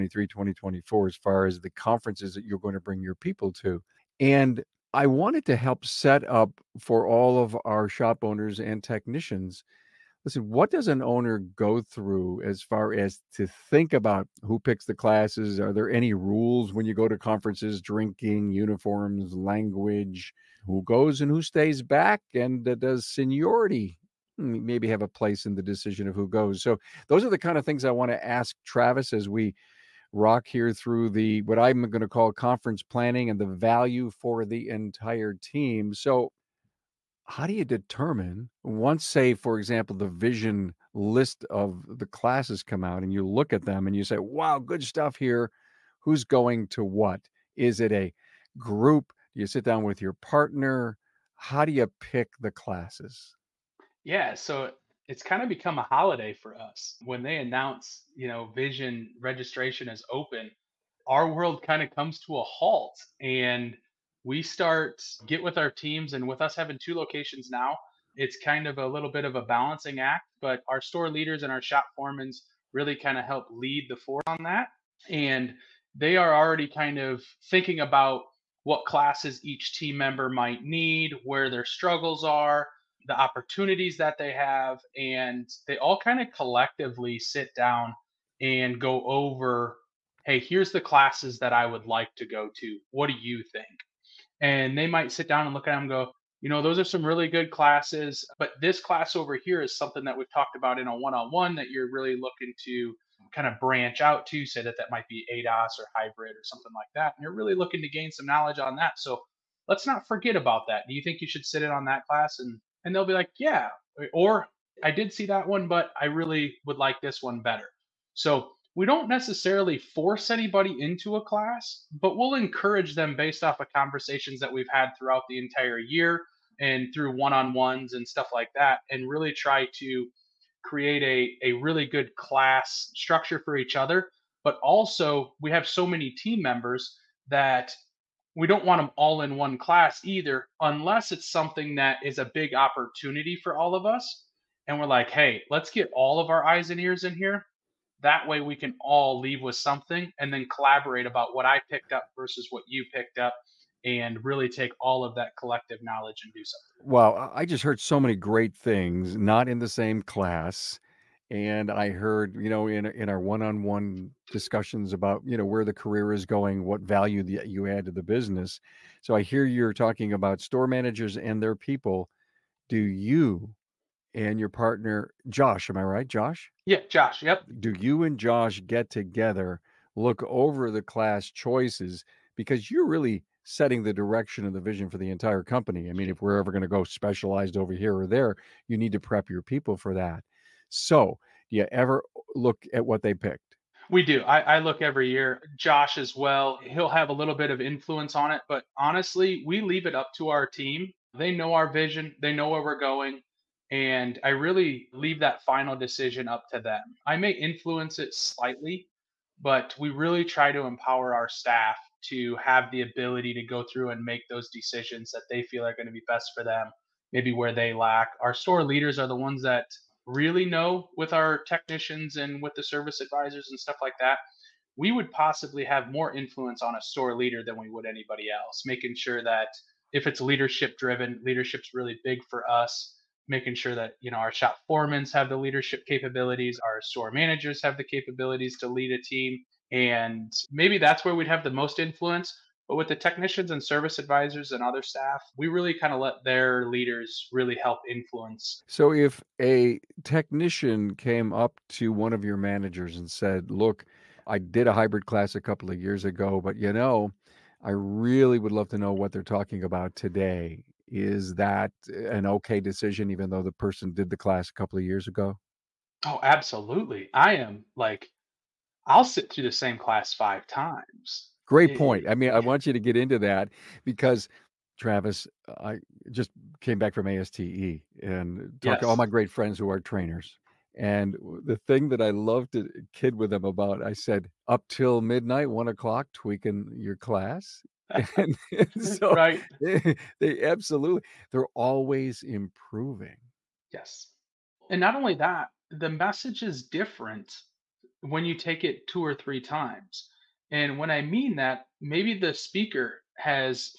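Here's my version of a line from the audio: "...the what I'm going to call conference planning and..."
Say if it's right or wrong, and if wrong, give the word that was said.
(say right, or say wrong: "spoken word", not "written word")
right.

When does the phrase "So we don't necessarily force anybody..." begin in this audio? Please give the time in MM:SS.
01:58.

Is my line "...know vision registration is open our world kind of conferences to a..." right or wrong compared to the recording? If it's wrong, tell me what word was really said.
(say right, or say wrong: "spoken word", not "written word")
wrong: "comes", not "conferences".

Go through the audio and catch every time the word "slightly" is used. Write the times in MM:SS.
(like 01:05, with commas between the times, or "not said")
03:28.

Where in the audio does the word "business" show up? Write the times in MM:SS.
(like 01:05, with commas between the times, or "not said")
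02:48.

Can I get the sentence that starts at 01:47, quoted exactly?
And you're really looking to gain some knowledge on that.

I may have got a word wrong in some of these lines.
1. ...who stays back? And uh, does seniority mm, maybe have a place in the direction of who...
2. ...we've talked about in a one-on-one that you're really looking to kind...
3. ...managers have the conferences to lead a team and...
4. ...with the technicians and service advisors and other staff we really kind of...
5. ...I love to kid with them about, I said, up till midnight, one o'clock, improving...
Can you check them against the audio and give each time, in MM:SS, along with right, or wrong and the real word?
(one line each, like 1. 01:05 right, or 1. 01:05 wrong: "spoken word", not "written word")
1. 00:21 wrong: "decision", not "direction"
2. 01:40 right
3. 03:57 wrong: "capabilities", not "conferences"
4. 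04:02 right
5. 04:42 wrong: "tweaking", not "improving".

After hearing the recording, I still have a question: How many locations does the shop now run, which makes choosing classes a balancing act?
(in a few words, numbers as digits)
2.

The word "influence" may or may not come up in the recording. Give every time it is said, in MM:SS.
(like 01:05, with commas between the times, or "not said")
03:17, 03:27, 03:46, 04:01, 04:07.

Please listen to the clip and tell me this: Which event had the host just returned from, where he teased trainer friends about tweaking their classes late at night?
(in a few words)
ASTE.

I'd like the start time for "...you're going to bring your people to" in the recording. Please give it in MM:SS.
00:02.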